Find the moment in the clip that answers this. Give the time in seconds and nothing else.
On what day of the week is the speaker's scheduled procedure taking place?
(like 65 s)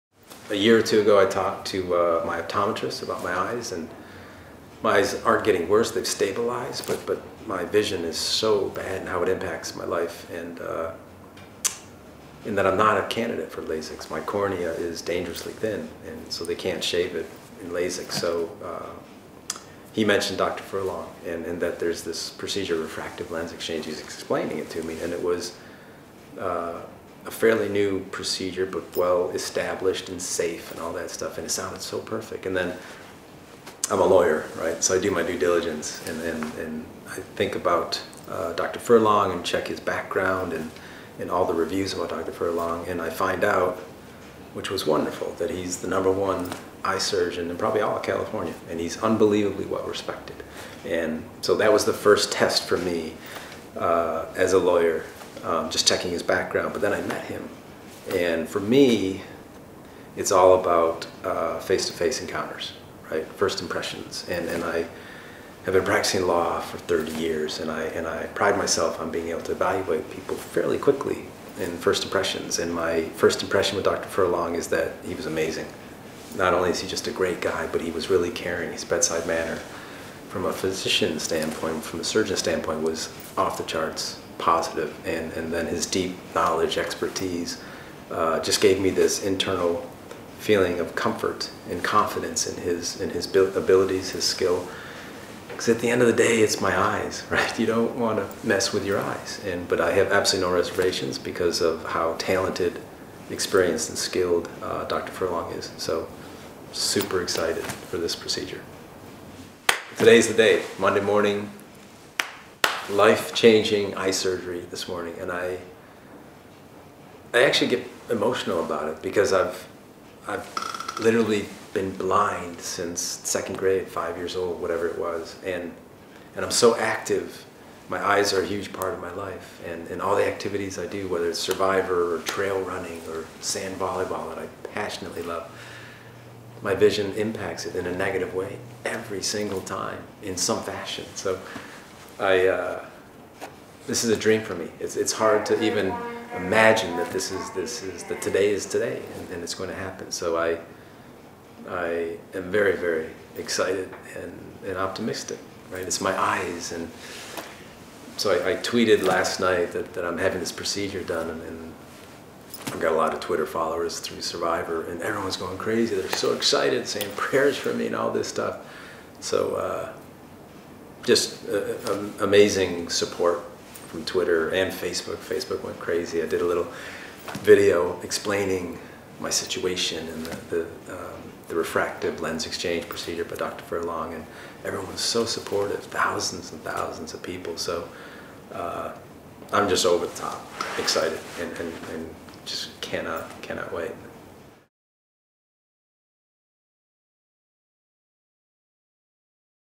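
110 s.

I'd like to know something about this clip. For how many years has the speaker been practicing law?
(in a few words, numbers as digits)
30.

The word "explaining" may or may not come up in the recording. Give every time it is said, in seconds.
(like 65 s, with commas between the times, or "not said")
23 s, 178 s.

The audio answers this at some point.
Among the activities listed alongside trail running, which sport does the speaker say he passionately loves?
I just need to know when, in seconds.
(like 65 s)
133 s.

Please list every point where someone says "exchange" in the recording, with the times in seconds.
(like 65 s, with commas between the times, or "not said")
23 s, 182 s.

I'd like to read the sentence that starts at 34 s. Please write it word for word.
So I do my due diligence and, and, and I think about uh, Dr.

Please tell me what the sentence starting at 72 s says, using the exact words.
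And my first impression with Dr.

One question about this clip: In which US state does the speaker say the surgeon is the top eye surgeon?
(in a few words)
California.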